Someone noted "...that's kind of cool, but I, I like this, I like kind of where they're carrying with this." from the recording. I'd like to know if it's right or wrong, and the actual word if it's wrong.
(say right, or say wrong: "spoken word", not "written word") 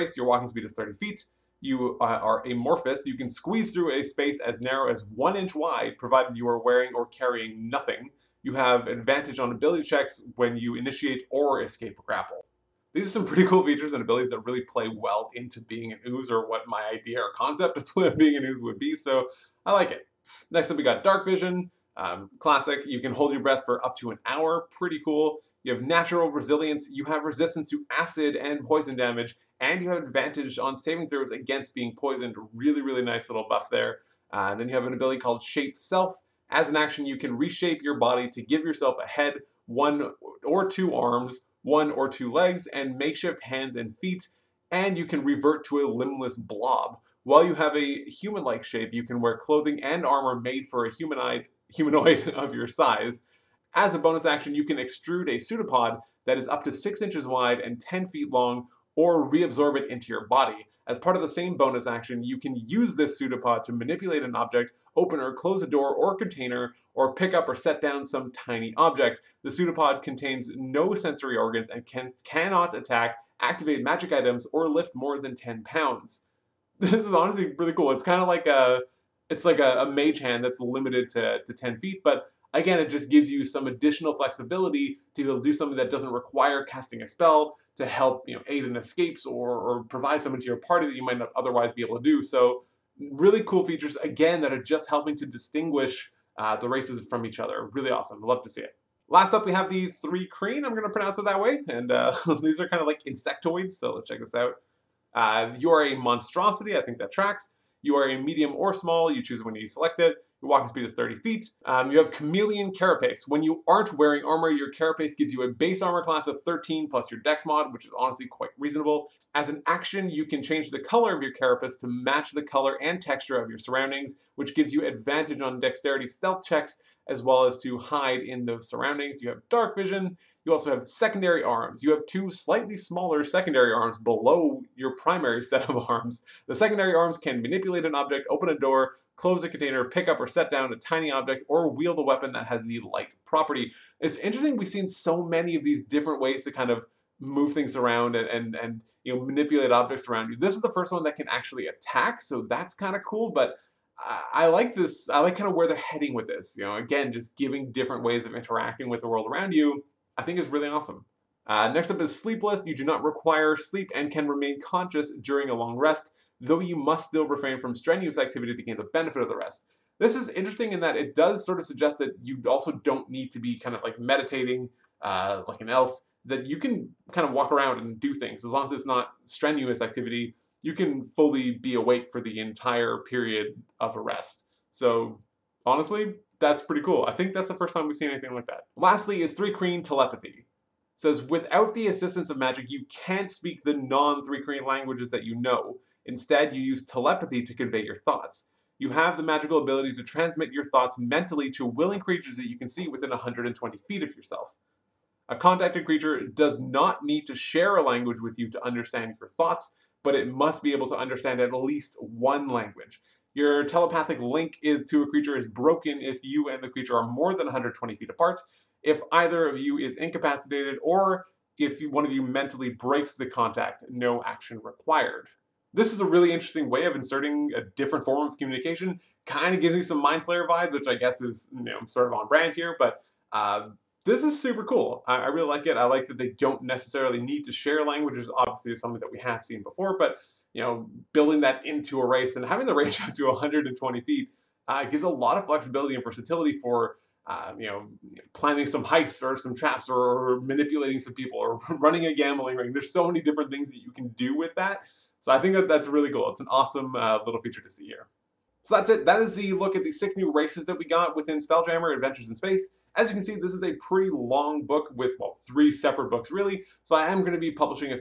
wrong: "heading", not "carrying".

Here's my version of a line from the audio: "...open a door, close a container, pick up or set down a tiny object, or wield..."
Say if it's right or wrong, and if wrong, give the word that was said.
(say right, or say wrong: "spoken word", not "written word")
right.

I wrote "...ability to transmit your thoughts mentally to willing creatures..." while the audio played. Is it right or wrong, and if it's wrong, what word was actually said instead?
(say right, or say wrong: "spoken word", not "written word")
right.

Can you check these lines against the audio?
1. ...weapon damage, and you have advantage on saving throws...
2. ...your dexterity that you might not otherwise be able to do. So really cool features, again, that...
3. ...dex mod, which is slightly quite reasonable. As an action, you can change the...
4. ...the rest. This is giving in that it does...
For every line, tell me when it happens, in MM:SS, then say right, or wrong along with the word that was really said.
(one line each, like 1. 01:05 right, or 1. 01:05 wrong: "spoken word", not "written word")
1. 00:28 wrong: "poison", not "weapon"
2. 01:30 wrong: "party", not "dexterity"
3. 01:57 wrong: "honestly", not "slightly"
4. 02:49 wrong: "interesting", not "giving".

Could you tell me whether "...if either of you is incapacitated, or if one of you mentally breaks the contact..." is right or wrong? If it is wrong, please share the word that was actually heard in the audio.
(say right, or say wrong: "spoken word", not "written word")
right.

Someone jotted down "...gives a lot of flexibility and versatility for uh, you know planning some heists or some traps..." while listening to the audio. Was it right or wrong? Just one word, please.
right.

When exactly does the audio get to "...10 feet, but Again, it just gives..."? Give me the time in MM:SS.
01:21.